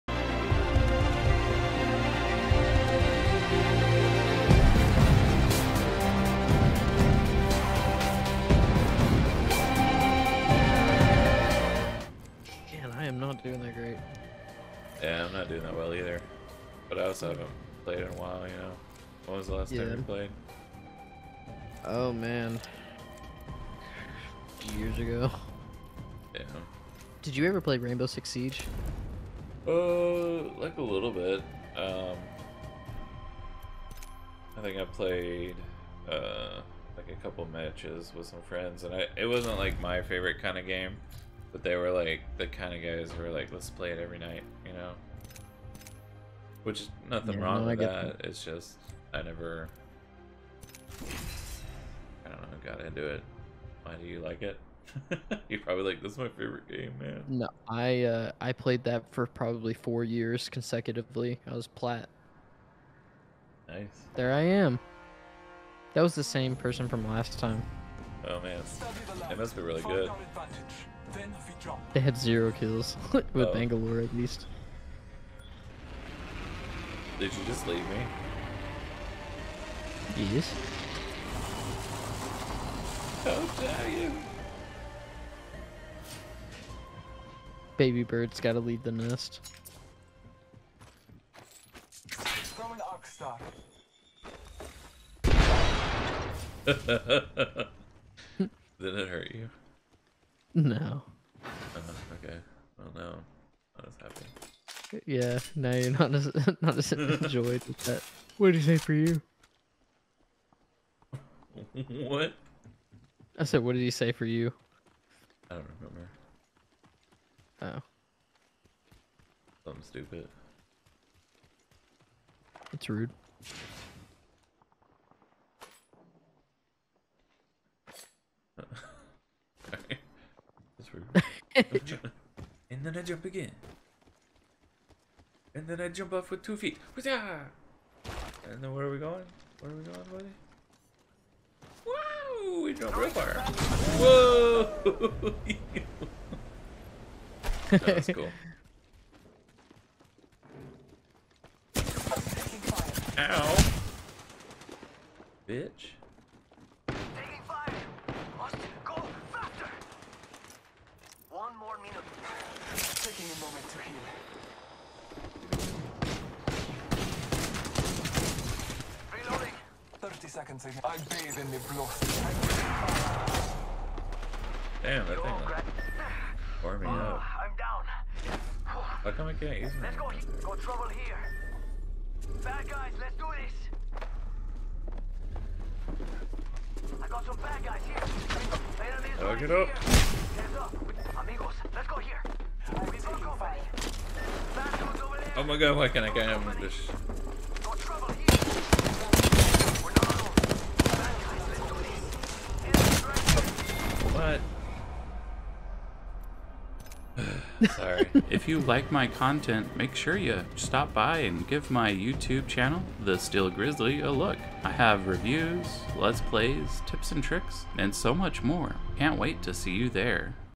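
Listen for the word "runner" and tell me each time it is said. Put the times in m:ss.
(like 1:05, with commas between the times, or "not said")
not said.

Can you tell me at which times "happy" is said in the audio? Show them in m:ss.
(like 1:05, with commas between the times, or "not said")
1:44.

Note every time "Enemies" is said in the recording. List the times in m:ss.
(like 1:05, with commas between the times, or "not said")
3:08.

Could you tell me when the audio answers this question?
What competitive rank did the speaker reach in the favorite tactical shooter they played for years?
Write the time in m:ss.
1:01.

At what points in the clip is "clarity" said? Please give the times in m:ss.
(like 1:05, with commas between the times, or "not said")
not said.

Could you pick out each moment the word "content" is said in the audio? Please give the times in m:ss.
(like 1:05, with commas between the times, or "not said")
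3:29.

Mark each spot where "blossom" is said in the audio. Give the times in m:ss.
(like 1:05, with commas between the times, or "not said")
2:51.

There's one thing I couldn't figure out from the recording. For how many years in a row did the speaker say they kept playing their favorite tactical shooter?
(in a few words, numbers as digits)
4.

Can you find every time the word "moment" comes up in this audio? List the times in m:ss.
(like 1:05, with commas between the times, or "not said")
2:43.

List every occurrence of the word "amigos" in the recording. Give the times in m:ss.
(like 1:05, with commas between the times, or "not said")
3:11.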